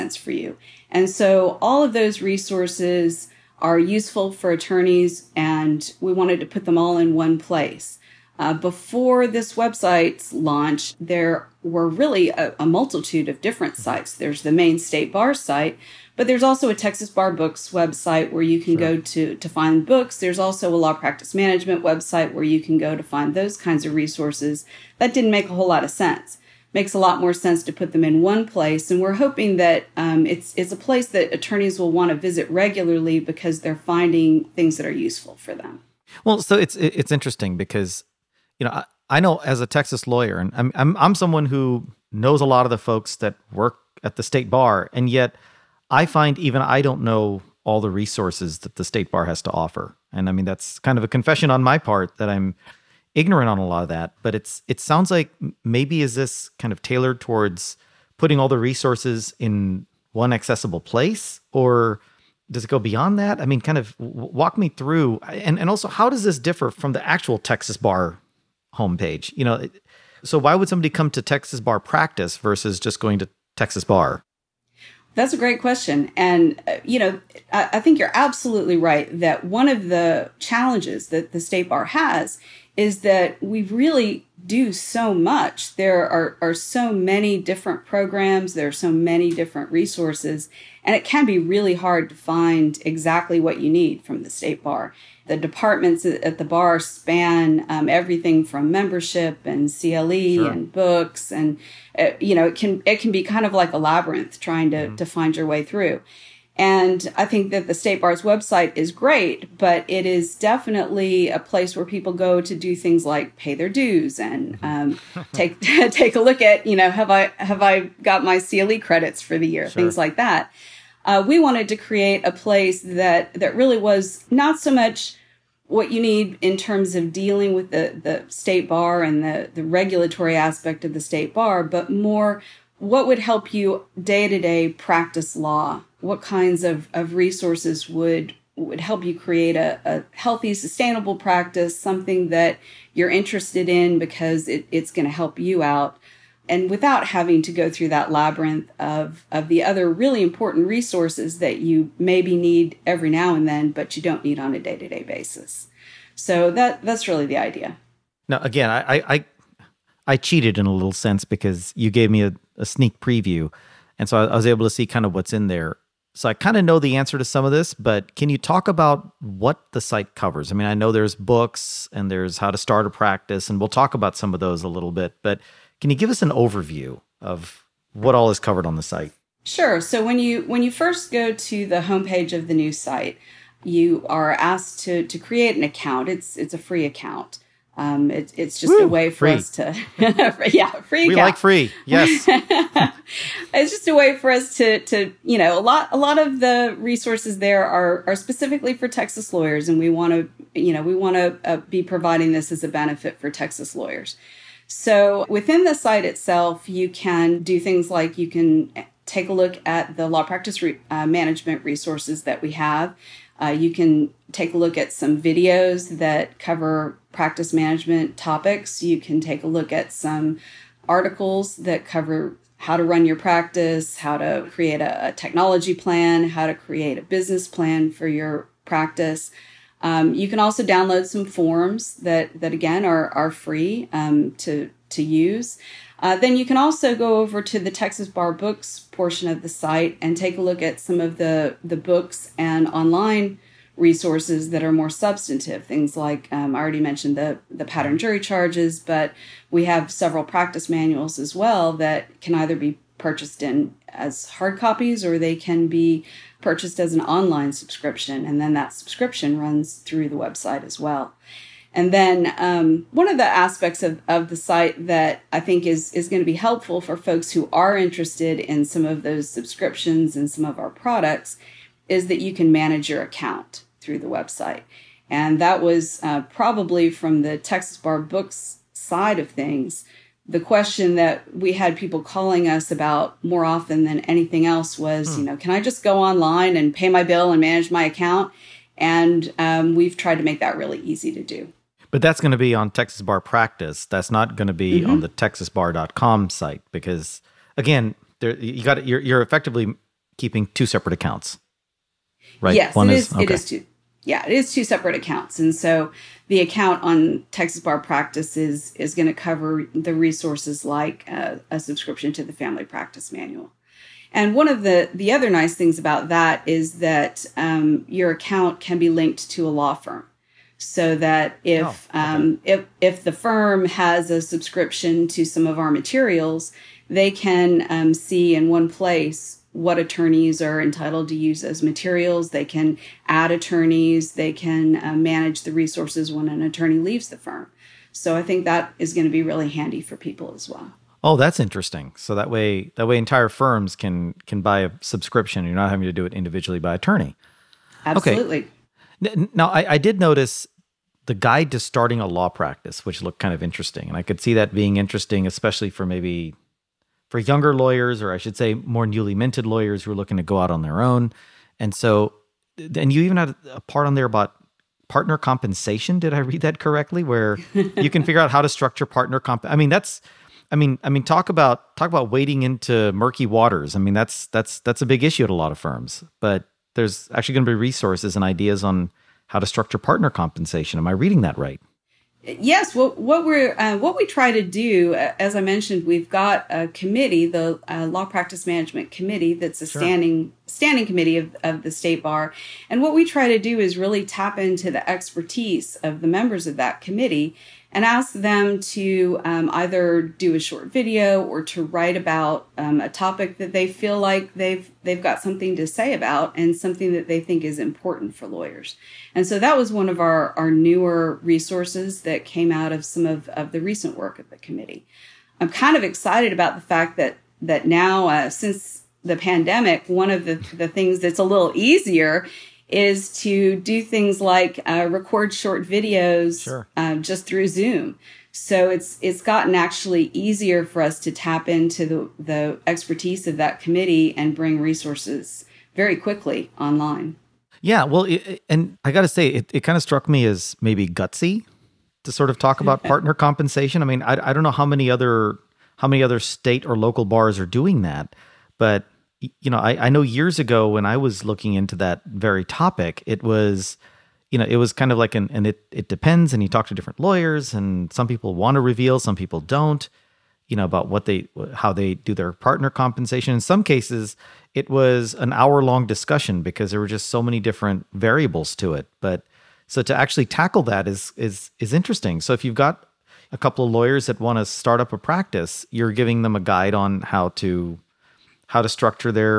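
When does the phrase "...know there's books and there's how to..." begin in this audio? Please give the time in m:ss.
2:50.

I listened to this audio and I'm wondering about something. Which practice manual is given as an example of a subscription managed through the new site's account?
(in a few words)
Family Practice Manual.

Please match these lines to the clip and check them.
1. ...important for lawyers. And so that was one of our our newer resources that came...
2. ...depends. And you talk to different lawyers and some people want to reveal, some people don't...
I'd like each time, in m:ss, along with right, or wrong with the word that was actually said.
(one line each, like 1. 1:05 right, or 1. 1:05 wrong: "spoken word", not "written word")
1. 6:47 right
2. 7:35 right.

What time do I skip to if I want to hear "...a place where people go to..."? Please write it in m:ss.
1:51.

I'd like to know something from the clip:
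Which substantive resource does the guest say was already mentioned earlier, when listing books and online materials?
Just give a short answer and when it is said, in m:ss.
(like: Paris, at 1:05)
pattern jury charges, at 4:07.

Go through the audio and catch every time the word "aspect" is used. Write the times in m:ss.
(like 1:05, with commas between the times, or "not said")
2:10, 4:23.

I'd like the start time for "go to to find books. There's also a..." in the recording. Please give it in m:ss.
0:18.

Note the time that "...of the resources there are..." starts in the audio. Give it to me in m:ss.
3:16.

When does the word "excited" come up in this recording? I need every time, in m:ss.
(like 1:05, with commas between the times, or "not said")
6:55.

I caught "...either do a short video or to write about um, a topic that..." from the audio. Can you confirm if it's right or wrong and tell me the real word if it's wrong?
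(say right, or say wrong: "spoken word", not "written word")
right.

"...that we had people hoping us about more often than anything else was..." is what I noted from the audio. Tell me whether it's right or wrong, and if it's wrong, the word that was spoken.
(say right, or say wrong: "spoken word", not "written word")
wrong: "calling", not "hoping".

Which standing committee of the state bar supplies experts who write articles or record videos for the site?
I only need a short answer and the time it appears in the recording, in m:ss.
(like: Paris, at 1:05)
Law Practice Management Committee, at 6:27.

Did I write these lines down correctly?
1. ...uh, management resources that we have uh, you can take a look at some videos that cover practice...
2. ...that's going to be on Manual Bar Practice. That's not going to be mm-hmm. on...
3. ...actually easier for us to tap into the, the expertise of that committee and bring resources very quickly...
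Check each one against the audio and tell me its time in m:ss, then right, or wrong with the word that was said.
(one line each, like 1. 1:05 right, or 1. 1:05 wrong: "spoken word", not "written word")
1. 3:30 right
2. 4:52 wrong: "Texas", not "Manual"
3. 7:09 right.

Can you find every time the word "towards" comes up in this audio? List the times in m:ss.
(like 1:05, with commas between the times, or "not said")
0:57.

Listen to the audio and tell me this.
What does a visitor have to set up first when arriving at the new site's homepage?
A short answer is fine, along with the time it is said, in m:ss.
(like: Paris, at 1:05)
an account, at 3:05.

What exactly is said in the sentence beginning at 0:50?
And I mean, that's kind of a confession on my part that I'm ignorant on a lot of that.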